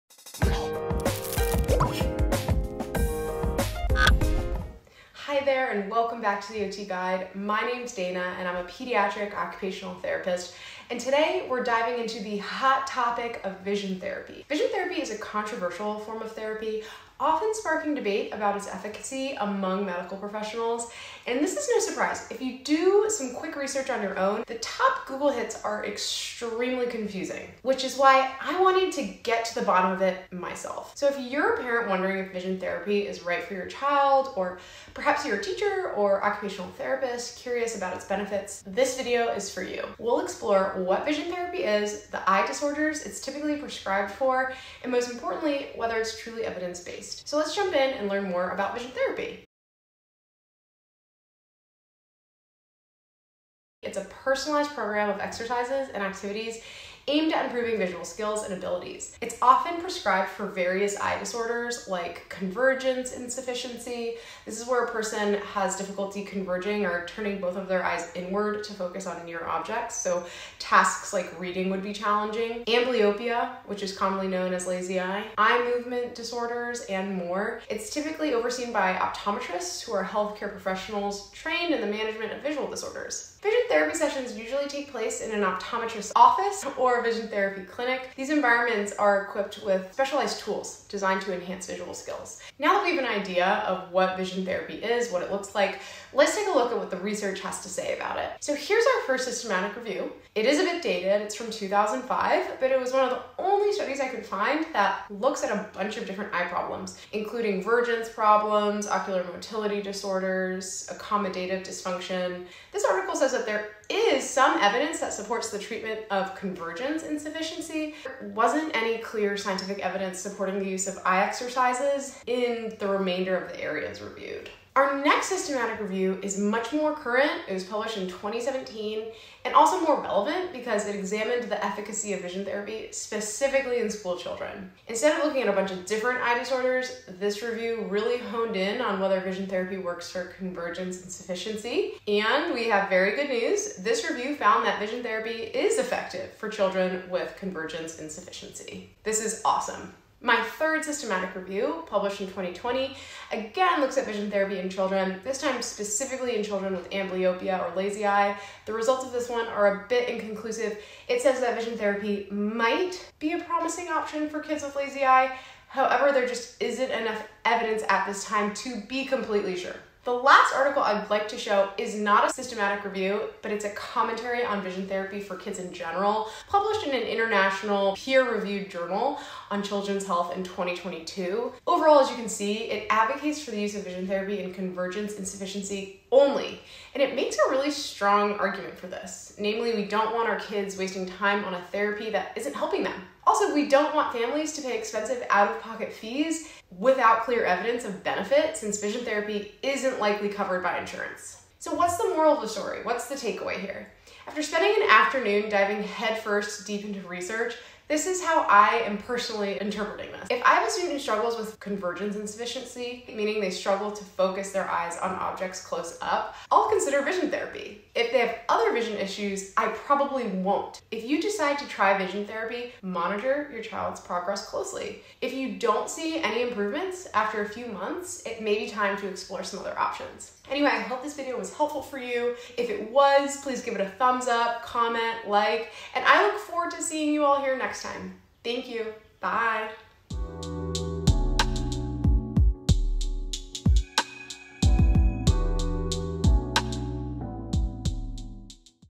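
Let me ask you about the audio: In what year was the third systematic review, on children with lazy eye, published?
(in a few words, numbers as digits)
2020.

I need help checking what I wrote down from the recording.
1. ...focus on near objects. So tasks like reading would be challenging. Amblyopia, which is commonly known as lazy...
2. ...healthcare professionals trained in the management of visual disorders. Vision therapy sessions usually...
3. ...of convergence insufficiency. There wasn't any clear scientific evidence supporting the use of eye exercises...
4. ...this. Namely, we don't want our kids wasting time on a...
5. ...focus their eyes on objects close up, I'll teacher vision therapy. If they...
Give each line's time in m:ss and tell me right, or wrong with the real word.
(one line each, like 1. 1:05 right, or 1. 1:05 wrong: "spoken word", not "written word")
1. 1:08 right
2. 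1:20 right
3. 1:56 right
4. 3:08 right
5. 3:34 wrong: "consider", not "teacher".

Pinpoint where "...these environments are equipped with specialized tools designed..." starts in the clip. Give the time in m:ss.
1:28.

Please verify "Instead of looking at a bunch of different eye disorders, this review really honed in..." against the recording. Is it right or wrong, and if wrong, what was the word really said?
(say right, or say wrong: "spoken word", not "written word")
right.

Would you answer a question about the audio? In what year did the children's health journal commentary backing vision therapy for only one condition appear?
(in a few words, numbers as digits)
2022.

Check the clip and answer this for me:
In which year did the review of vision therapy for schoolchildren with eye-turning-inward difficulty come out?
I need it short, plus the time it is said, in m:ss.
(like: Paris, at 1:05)
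2017, at 2:08.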